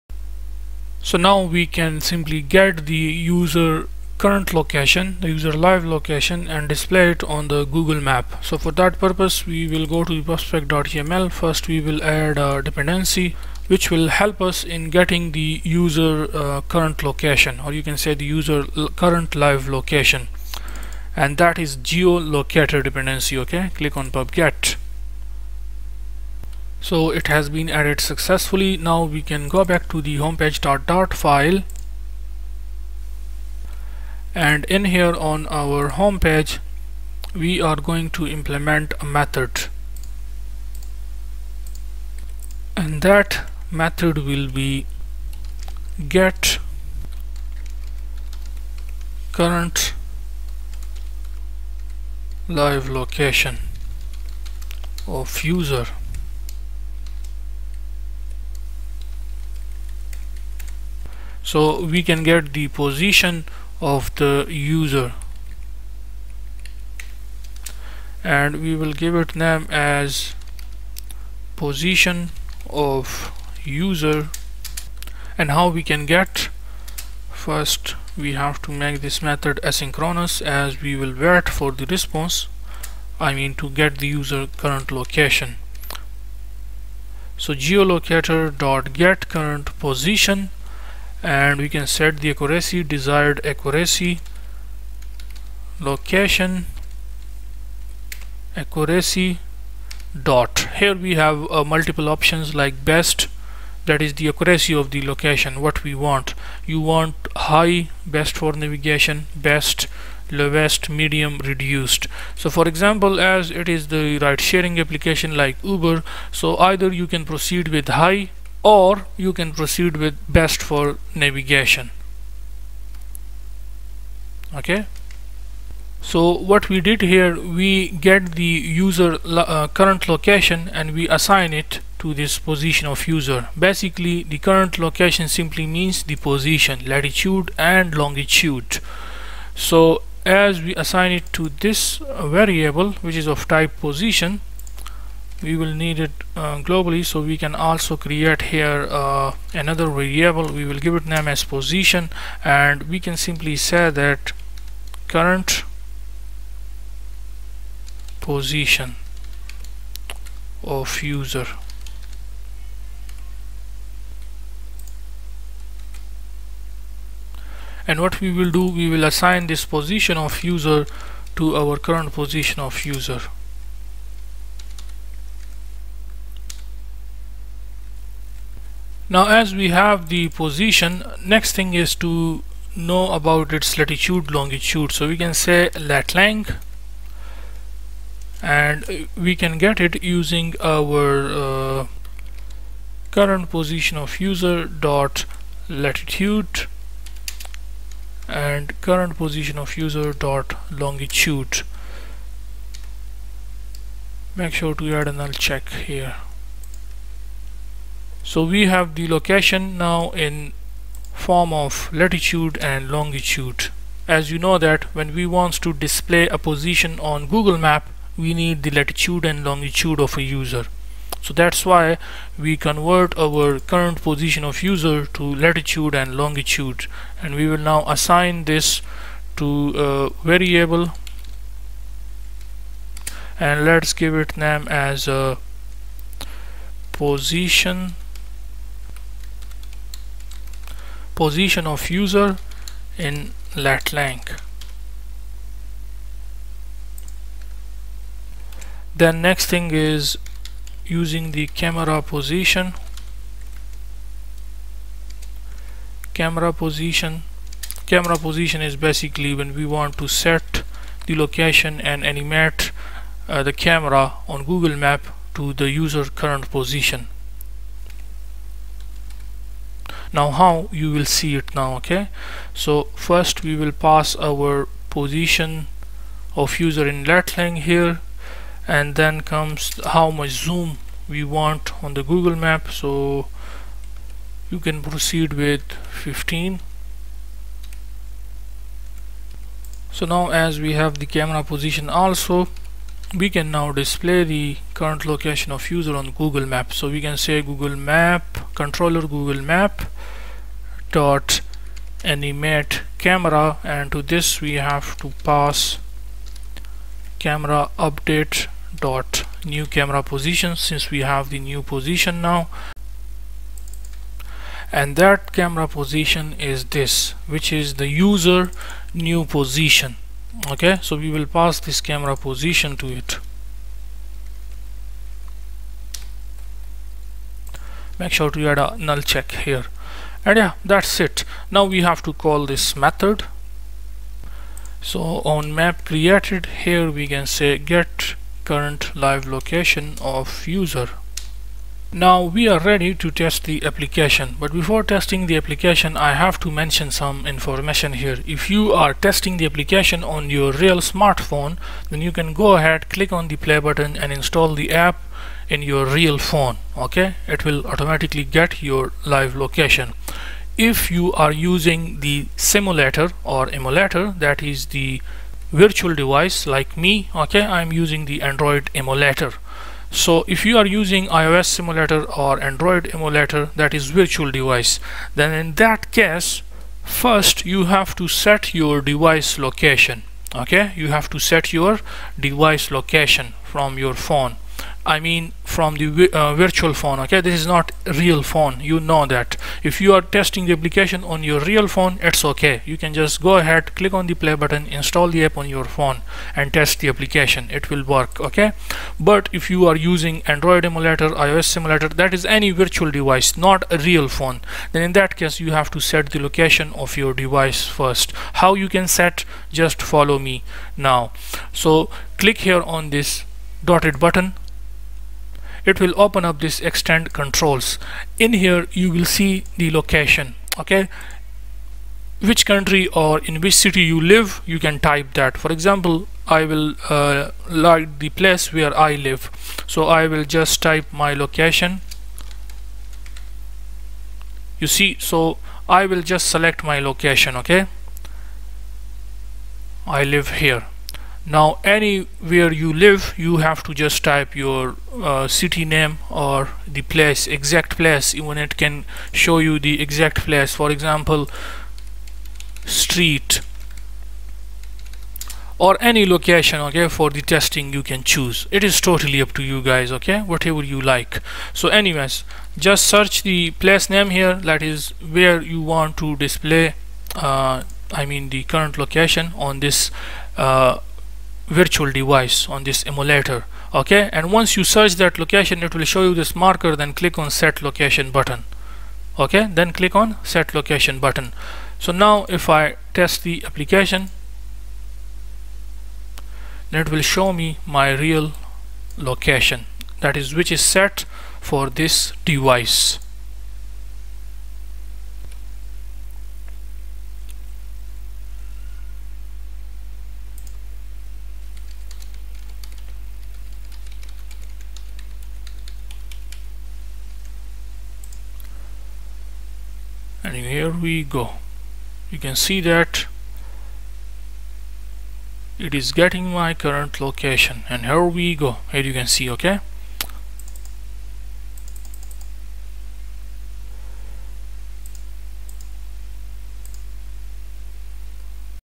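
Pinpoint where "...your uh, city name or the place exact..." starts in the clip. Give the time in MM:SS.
07:24.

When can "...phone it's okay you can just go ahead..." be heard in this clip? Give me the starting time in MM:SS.
06:31.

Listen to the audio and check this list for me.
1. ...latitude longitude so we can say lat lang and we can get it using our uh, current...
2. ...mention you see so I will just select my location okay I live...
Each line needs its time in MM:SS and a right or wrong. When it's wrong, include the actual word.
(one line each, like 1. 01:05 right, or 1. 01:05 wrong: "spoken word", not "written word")
1. 03:03 right
2. 07:11 wrong: "location", not "mention".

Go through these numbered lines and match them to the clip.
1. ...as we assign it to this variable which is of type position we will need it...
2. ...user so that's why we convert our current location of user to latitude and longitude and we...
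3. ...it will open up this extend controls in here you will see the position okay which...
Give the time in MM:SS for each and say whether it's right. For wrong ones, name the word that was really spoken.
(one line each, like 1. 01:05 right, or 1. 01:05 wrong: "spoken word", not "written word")
1. 02:20 right
2. 03:40 wrong: "position", not "location"
3. 06:55 wrong: "location", not "position".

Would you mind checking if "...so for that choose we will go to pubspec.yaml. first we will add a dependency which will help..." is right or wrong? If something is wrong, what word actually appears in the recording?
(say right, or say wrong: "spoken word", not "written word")
wrong: "purpose", not "choose".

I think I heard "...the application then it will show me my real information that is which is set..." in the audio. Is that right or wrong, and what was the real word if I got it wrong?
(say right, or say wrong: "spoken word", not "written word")
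wrong: "location", not "information".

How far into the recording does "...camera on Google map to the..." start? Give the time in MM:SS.
04:23.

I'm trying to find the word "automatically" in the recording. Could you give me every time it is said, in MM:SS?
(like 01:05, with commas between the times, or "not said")
05:57.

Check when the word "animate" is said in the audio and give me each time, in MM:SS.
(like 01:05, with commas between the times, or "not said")
04:22, 05:02.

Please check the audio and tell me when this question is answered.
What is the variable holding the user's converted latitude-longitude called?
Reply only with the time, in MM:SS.
04:01.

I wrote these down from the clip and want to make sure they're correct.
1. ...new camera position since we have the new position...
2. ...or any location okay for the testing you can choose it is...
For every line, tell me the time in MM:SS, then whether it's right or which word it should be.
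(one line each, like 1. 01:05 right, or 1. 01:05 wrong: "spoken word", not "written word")
1. 05:09 right
2. 07:35 right.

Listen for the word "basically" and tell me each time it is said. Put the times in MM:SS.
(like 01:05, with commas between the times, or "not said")
02:13, 04:18.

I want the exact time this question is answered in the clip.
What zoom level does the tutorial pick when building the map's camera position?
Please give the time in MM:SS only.
04:46.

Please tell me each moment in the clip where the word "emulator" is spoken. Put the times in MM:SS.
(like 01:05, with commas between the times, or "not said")
06:03, 06:08, 06:12, 06:40, 07:52.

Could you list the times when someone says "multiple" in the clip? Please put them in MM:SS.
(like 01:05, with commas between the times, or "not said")
01:41.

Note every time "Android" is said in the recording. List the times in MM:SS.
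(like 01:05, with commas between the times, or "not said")
06:08, 06:12, 06:40.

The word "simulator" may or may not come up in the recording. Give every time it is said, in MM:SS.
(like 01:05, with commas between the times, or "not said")
06:02, 06:11, 06:41.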